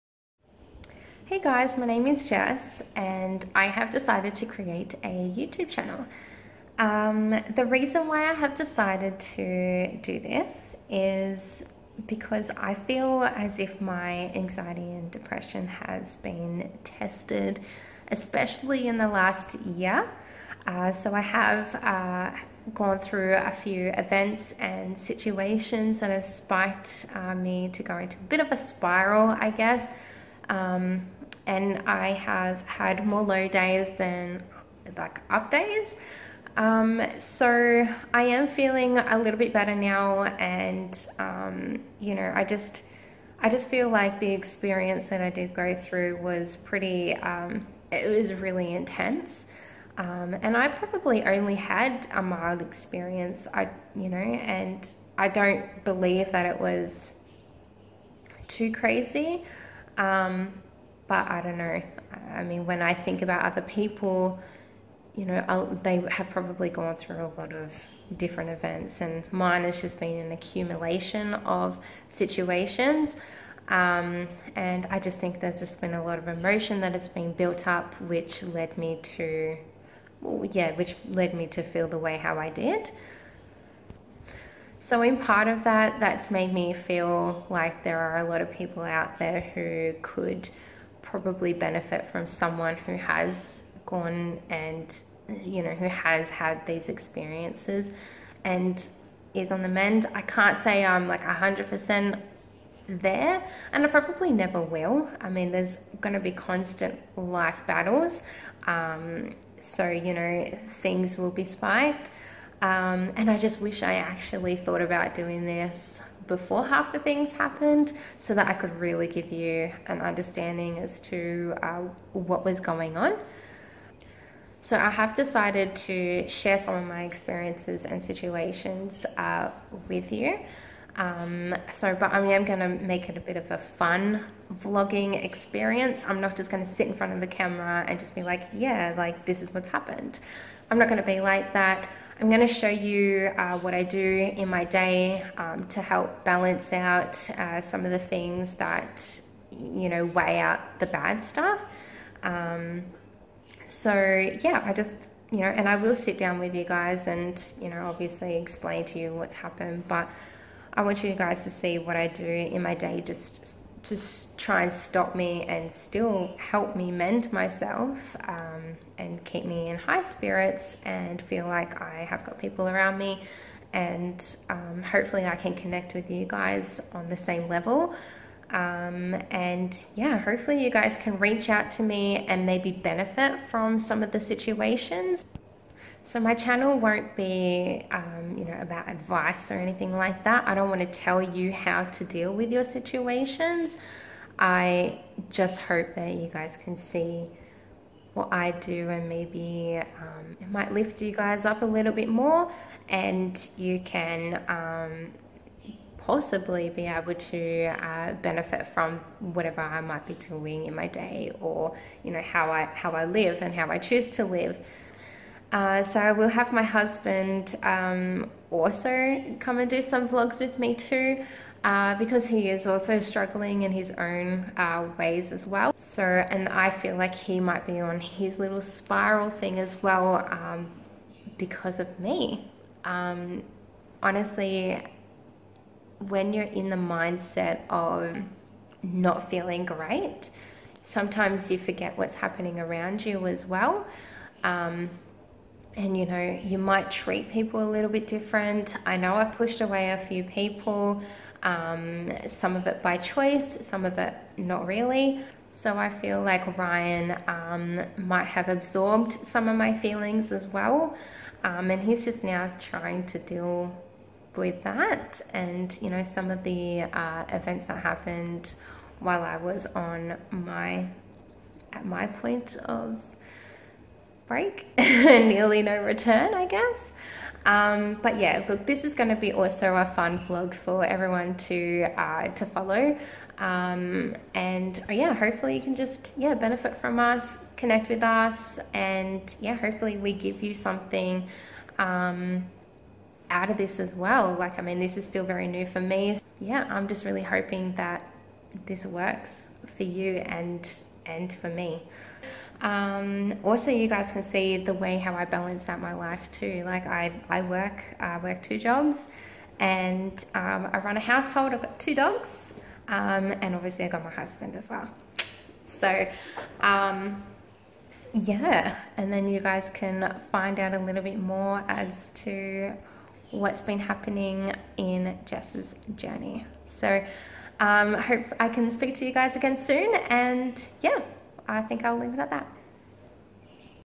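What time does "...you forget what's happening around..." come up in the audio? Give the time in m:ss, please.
4:01.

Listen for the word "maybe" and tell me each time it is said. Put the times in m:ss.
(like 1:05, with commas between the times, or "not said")
3:02, 3:19.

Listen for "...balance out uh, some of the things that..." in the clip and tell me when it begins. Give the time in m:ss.
2:26.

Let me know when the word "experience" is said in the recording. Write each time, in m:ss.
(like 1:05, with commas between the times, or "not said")
0:44, 0:52, 1:36, 2:07, 2:15.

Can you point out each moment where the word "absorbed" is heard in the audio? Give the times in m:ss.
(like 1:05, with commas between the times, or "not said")
4:18.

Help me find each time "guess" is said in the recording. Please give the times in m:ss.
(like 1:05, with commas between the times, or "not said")
0:29, 4:36.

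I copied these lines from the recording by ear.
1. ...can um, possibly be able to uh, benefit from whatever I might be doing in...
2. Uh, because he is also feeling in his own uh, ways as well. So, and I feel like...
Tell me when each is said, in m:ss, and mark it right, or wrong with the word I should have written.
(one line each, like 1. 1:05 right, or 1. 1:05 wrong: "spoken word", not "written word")
1. 3:23 right
2. 3:41 wrong: "struggling", not "feeling".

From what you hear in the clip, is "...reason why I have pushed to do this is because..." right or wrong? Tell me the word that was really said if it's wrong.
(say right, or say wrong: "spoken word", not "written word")
wrong: "decided", not "pushed".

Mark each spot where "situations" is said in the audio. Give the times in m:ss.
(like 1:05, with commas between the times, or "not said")
0:24, 1:12, 2:08, 3:04, 3:12.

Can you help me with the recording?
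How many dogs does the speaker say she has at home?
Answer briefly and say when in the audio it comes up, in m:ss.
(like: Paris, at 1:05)
2, at 5:11.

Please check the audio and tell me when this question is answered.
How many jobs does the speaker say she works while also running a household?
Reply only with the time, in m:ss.
5:08.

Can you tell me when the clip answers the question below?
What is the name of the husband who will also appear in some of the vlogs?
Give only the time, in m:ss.
4:16.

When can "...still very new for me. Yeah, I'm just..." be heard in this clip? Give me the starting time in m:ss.
4:55.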